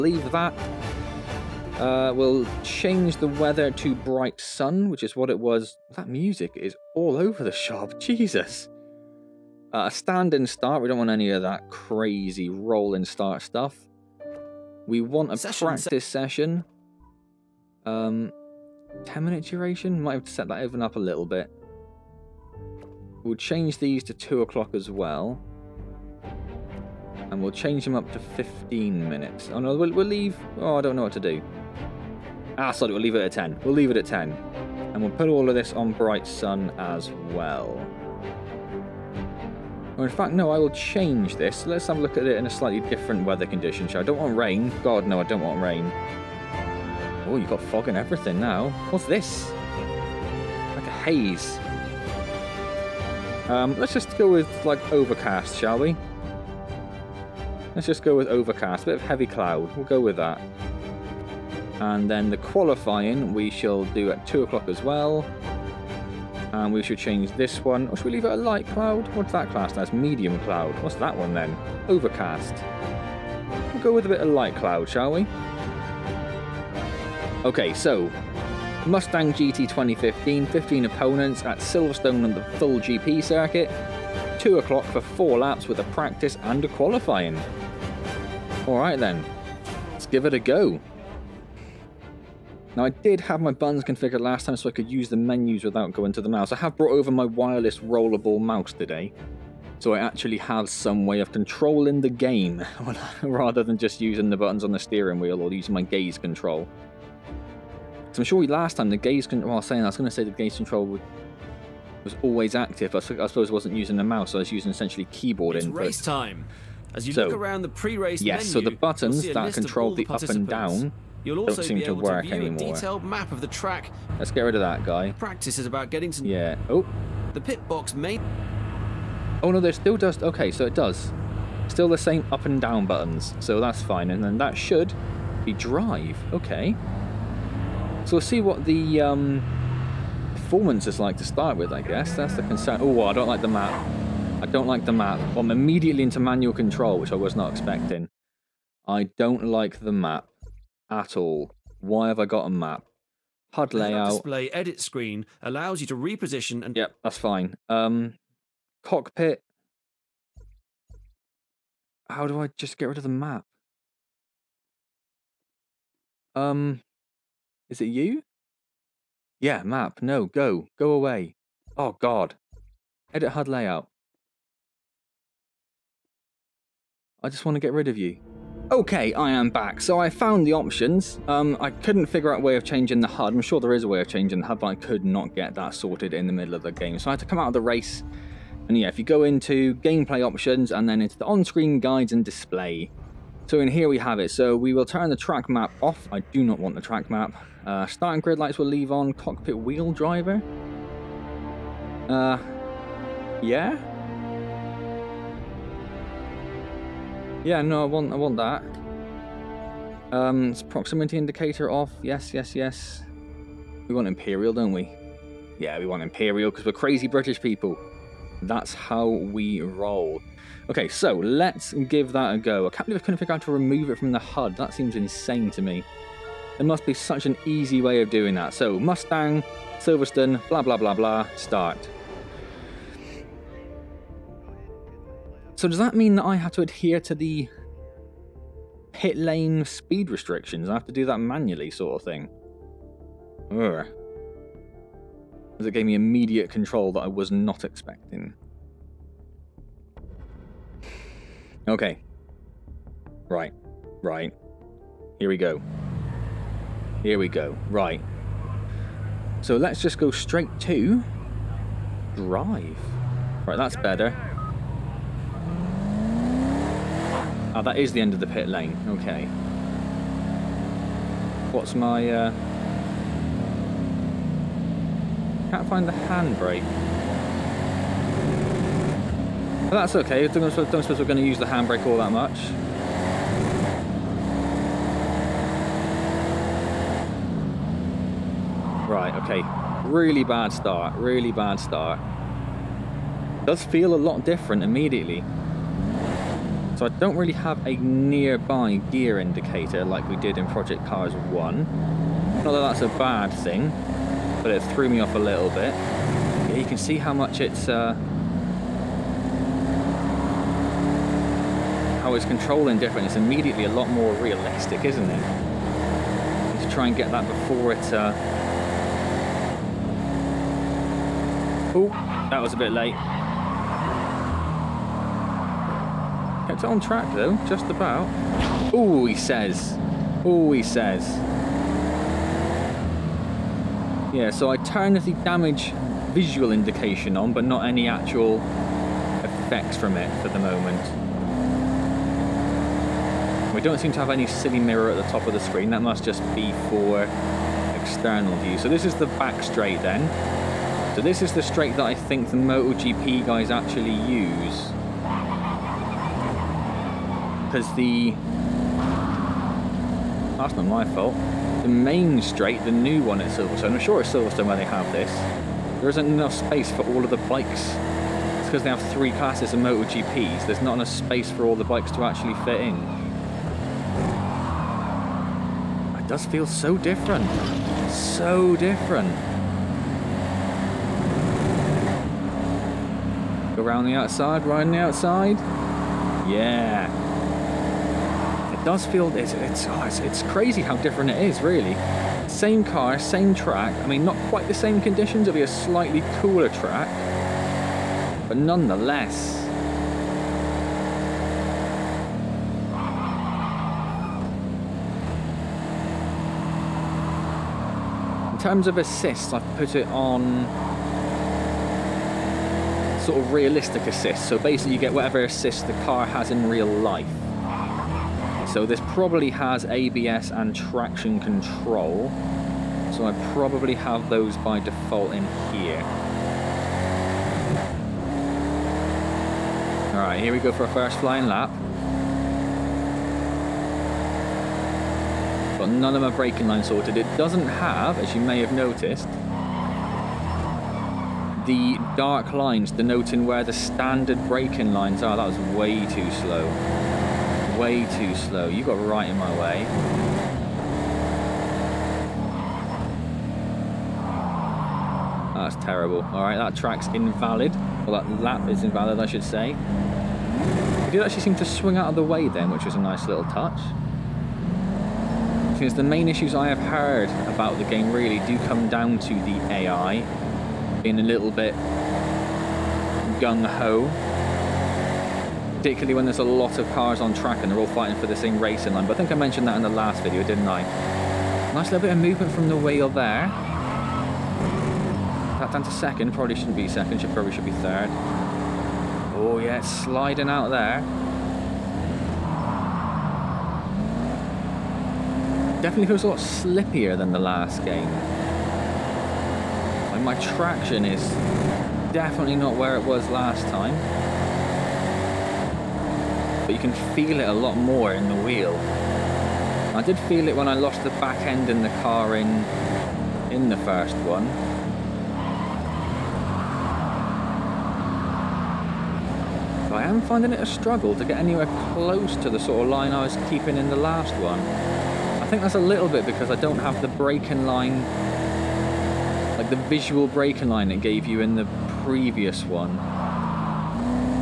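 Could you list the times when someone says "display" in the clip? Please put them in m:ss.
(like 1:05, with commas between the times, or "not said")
2:34, 3:12.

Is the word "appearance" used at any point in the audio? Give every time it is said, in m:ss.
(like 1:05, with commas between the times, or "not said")
not said.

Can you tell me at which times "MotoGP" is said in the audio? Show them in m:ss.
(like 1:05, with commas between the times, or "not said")
5:52, 6:09.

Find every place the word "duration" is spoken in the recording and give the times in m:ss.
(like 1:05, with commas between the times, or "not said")
0:19.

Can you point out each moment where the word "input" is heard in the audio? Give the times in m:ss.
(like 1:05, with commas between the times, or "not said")
1:55.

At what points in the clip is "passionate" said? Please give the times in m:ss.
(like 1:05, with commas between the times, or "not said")
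not said.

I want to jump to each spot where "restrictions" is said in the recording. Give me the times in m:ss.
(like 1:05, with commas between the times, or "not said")
4:00.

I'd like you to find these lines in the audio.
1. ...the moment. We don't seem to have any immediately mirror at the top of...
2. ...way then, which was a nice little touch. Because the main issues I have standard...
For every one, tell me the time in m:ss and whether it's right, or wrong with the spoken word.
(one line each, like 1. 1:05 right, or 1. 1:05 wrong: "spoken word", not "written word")
1. 5:40 wrong: "silly", not "immediately"
2. 7:42 wrong: "heard", not "standard".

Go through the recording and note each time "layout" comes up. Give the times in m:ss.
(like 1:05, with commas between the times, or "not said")
2:33, 2:53.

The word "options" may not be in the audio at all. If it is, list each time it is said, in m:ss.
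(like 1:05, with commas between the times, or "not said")
3:00, 3:10.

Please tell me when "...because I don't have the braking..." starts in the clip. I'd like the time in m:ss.
8:46.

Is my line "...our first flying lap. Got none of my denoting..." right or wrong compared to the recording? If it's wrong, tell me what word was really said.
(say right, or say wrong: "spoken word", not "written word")
wrong: "braking", not "denoting".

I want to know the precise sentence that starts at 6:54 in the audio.
So basically you get whatever assist the car has in real life.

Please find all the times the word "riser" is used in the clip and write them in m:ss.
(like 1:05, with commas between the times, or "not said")
not said.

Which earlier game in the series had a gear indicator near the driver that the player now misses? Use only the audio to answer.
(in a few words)
Project Cars 1.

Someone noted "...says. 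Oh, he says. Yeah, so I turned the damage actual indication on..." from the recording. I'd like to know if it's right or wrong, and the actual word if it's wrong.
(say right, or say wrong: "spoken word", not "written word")
wrong: "visual", not "actual".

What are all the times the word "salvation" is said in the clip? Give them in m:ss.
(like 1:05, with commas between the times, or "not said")
not said.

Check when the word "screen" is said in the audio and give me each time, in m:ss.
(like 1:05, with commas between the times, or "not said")
2:34, 3:11, 5:45.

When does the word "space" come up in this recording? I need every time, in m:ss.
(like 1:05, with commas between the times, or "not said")
6:06, 6:10.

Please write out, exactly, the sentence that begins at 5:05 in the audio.
Yeah, you can see how much it's...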